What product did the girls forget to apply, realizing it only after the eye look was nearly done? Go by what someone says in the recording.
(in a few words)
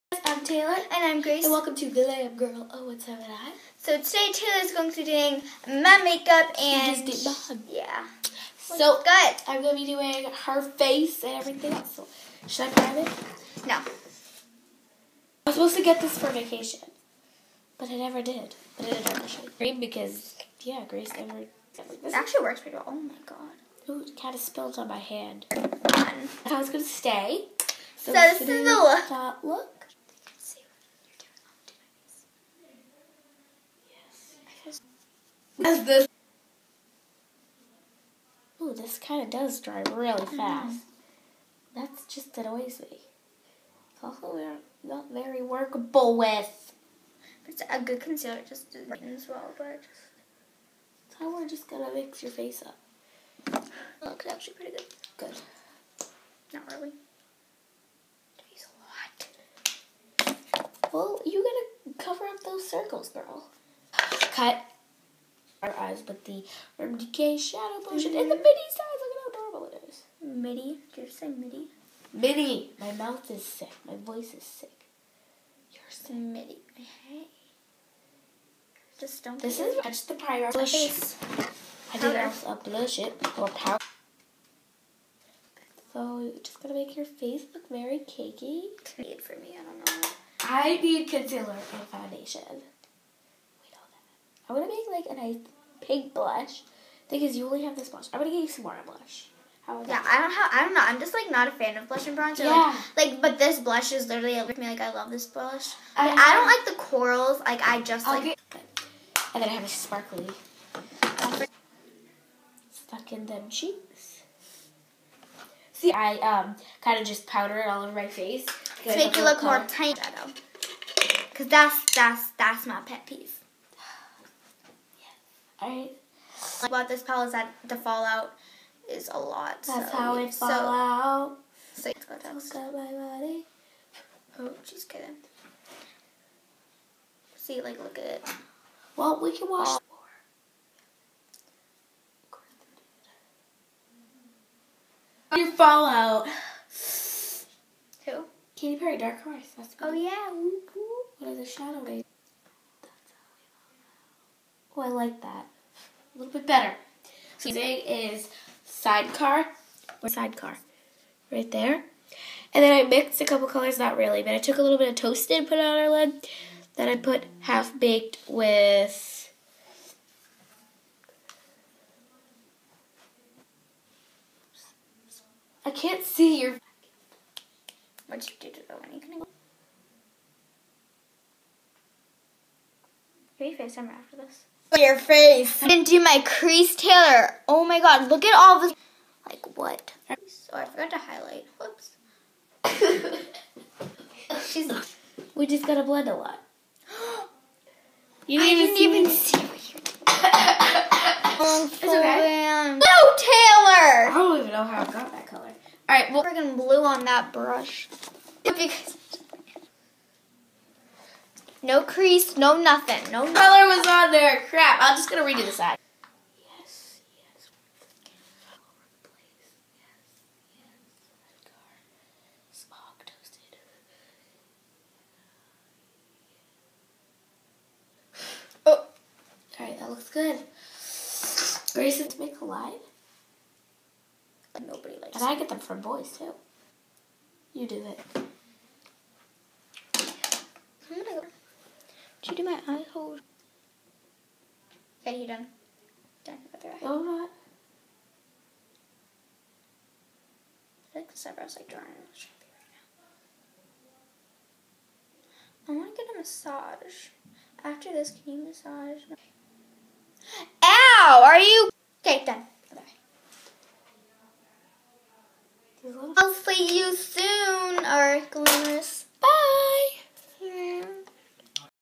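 Highlight.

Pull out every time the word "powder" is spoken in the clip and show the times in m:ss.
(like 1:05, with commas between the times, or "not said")
1:23, 1:57.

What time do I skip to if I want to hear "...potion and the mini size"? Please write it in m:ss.
1:07.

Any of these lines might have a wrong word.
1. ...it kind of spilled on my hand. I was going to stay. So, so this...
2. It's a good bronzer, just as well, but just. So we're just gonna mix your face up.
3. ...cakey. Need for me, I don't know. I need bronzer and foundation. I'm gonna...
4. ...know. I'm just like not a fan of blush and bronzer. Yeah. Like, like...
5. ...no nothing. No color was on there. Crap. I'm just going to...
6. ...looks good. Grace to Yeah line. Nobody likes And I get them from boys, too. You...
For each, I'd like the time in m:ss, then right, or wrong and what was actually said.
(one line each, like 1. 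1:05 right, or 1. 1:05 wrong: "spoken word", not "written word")
1. 0:24 right
2. 0:47 wrong: "concealer", not "bronzer"
3. 1:28 wrong: "concealer", not "bronzer"
4. 1:40 right
5. 3:32 right
6. 3:49 wrong: "Make", not "Yeah".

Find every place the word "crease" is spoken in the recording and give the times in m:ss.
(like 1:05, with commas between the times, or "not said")
3:06, 3:31.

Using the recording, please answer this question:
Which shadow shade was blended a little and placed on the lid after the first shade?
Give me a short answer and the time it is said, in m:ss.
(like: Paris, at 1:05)
Toasted, at 2:44.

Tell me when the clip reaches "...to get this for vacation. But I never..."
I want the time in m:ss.
0:15.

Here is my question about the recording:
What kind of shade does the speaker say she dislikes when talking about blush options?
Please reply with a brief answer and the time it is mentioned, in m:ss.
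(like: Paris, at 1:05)
Corals, at 1:46.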